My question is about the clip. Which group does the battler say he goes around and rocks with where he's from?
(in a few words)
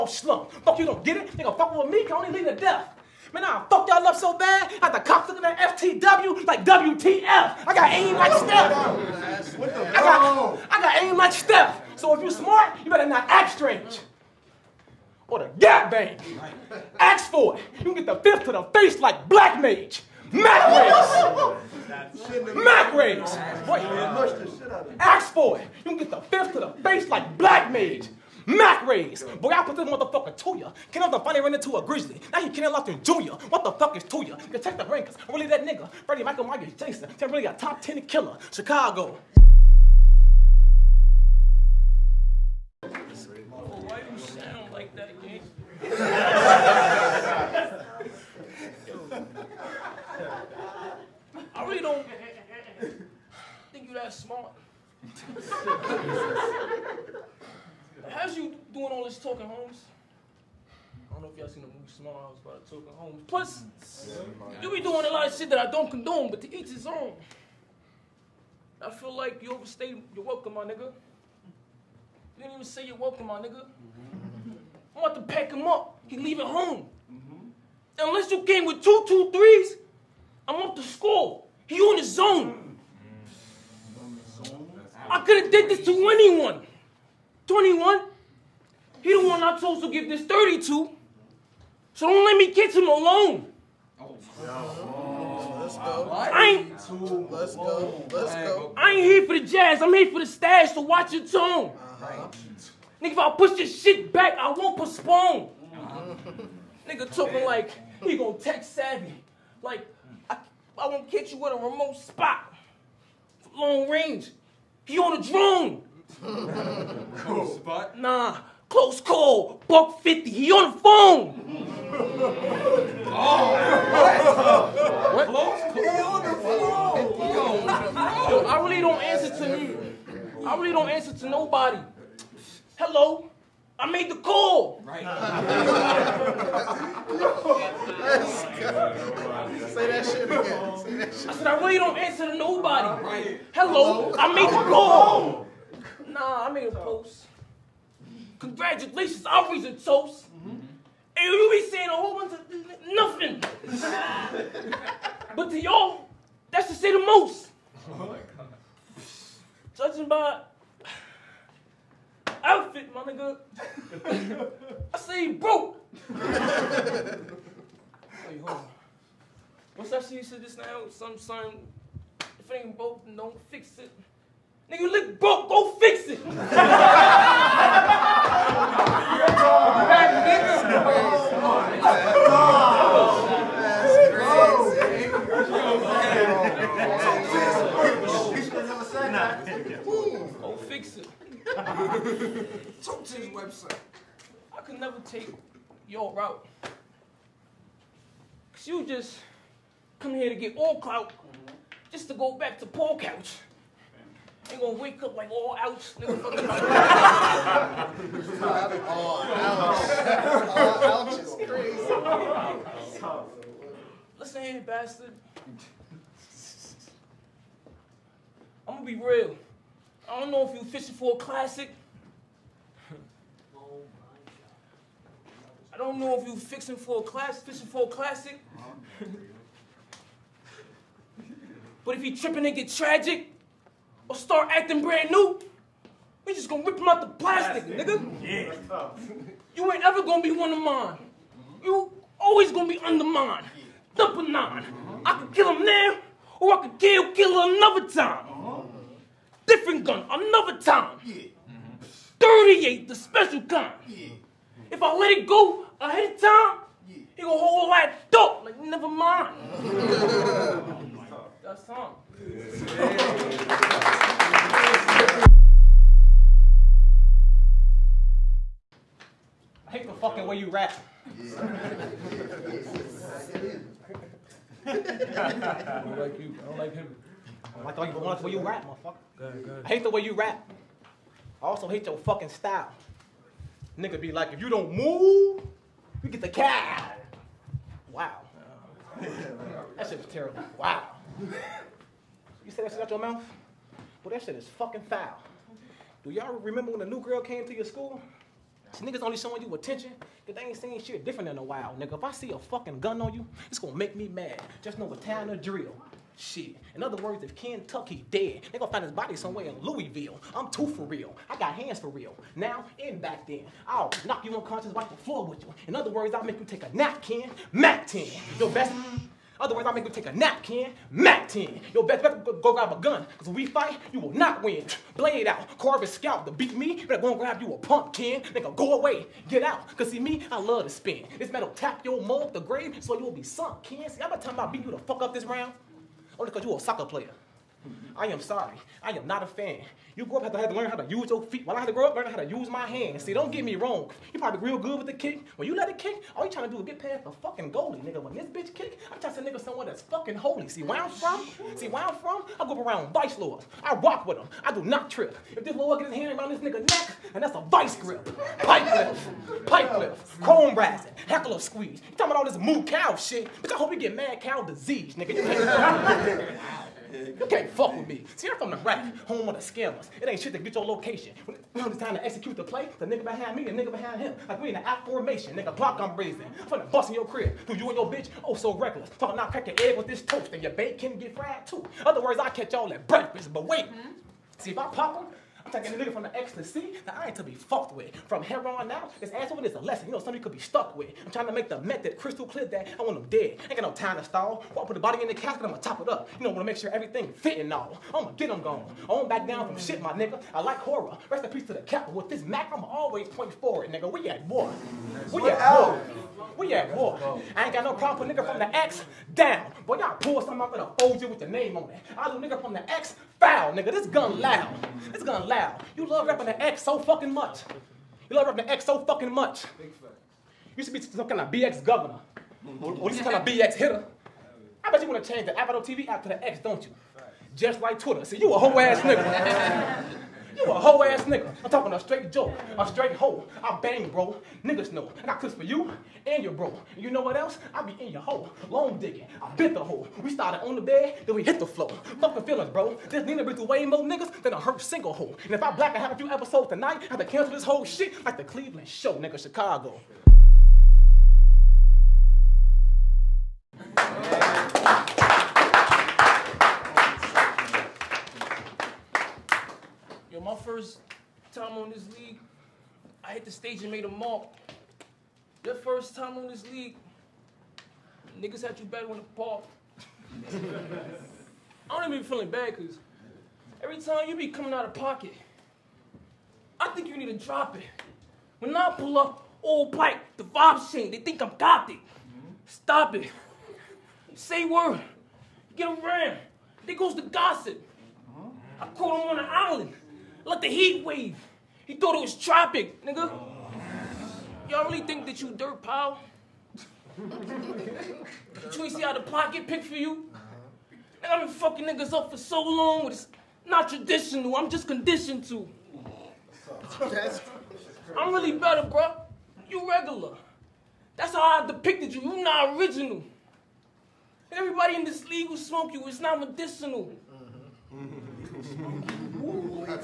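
Vice Lords.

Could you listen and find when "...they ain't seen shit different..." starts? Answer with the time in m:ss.
5:00.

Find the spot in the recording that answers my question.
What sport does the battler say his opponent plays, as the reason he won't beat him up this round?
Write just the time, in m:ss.
5:36.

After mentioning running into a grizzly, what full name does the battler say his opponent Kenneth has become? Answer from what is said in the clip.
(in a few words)
Kenneth Lofton Jr.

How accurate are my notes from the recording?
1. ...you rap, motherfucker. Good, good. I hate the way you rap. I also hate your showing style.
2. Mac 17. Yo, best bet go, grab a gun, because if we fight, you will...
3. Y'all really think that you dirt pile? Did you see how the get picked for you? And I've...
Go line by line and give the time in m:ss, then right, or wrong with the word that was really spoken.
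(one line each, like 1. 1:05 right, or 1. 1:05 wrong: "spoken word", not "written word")
1. 4:38 wrong: "fucking", not "showing"
2. 5:20 wrong: "10", not "17"
3. 8:14 right.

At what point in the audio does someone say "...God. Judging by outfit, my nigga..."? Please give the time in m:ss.
2:38.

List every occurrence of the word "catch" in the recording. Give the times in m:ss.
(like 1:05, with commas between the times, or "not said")
1:32, 1:51, 6:22.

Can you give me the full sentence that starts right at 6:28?
From here on out, this asshole is a lesson.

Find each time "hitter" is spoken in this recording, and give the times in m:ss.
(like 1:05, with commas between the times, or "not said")
7:03.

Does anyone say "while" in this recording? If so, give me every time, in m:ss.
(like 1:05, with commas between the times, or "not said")
5:01, 5:41.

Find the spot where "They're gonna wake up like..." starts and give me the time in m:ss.
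3:24.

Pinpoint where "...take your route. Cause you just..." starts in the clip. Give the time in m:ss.
3:15.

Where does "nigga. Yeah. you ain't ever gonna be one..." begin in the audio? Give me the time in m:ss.
3:57.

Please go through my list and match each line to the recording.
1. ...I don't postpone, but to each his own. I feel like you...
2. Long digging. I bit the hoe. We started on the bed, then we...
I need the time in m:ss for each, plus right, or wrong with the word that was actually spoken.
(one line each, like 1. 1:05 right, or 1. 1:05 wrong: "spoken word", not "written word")
1. 1:05 wrong: "condone", not "postpone"
2. 7:18 right.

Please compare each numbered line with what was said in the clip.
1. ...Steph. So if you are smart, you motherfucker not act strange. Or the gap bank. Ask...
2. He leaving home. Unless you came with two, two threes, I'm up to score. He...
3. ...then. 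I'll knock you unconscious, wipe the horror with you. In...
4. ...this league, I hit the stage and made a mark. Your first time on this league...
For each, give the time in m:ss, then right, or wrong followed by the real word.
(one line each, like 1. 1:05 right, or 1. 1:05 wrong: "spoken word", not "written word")
1. 0:11 wrong: "better", not "motherfucker"
2. 1:16 right
3. 5:13 wrong: "floor", not "horror"
4. 7:41 right.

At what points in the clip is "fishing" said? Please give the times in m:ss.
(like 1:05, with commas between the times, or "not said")
3:40, 3:47.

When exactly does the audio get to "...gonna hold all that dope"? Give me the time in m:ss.
4:17.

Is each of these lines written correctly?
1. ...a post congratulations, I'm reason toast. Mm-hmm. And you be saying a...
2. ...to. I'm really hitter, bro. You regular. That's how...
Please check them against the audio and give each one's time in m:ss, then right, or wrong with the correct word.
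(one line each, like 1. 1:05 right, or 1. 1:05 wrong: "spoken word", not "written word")
1. 2:26 right
2. 8:25 wrong: "better", not "hitter".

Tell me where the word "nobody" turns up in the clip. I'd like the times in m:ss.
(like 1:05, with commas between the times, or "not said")
2:11, 2:22.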